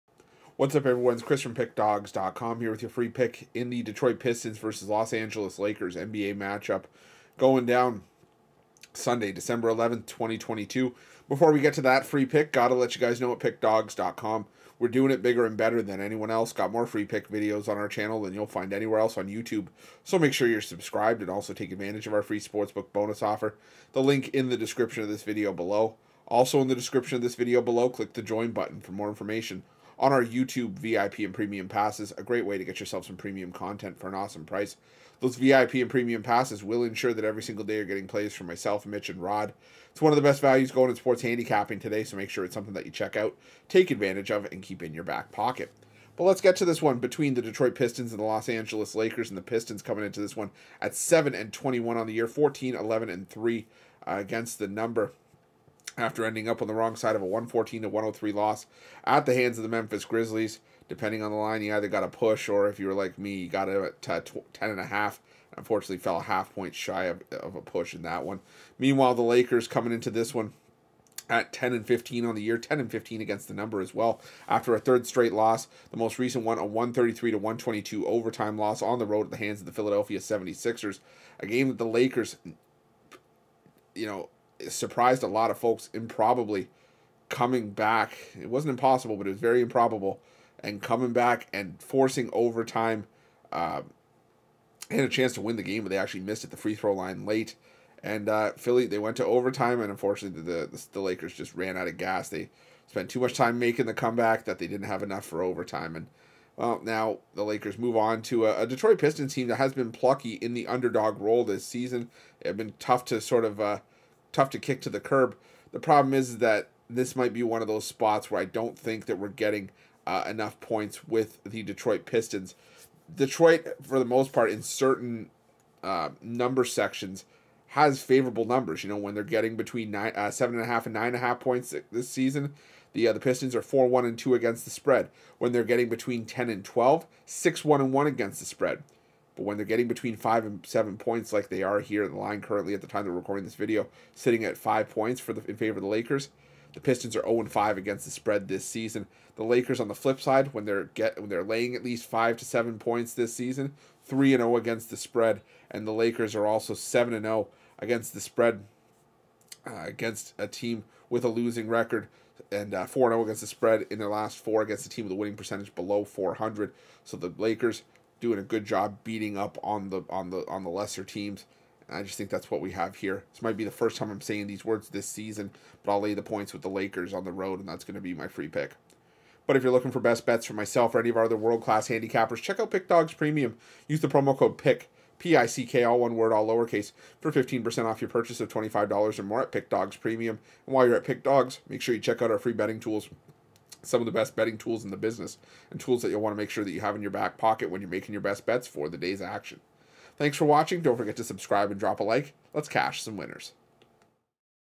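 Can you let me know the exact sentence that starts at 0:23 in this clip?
The link in the description of this video below.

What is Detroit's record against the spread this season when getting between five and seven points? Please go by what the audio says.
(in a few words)
0-5.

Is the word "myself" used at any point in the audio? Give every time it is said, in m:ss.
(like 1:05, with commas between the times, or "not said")
0:38, 3:00.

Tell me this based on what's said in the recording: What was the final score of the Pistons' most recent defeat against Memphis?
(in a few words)
114-103.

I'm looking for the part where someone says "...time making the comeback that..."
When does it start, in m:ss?
1:43.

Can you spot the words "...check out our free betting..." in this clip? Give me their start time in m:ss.
3:12.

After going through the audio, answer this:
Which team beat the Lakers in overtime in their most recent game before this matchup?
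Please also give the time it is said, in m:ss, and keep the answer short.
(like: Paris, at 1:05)
Philadelphia 76ers, at 1:19.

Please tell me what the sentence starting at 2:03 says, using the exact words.
Detroit, for the most part, in certain uh, number sections, has favorable numbers.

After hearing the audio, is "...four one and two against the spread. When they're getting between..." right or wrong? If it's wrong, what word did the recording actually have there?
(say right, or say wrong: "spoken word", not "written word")
right.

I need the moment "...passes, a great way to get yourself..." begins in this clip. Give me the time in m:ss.
0:31.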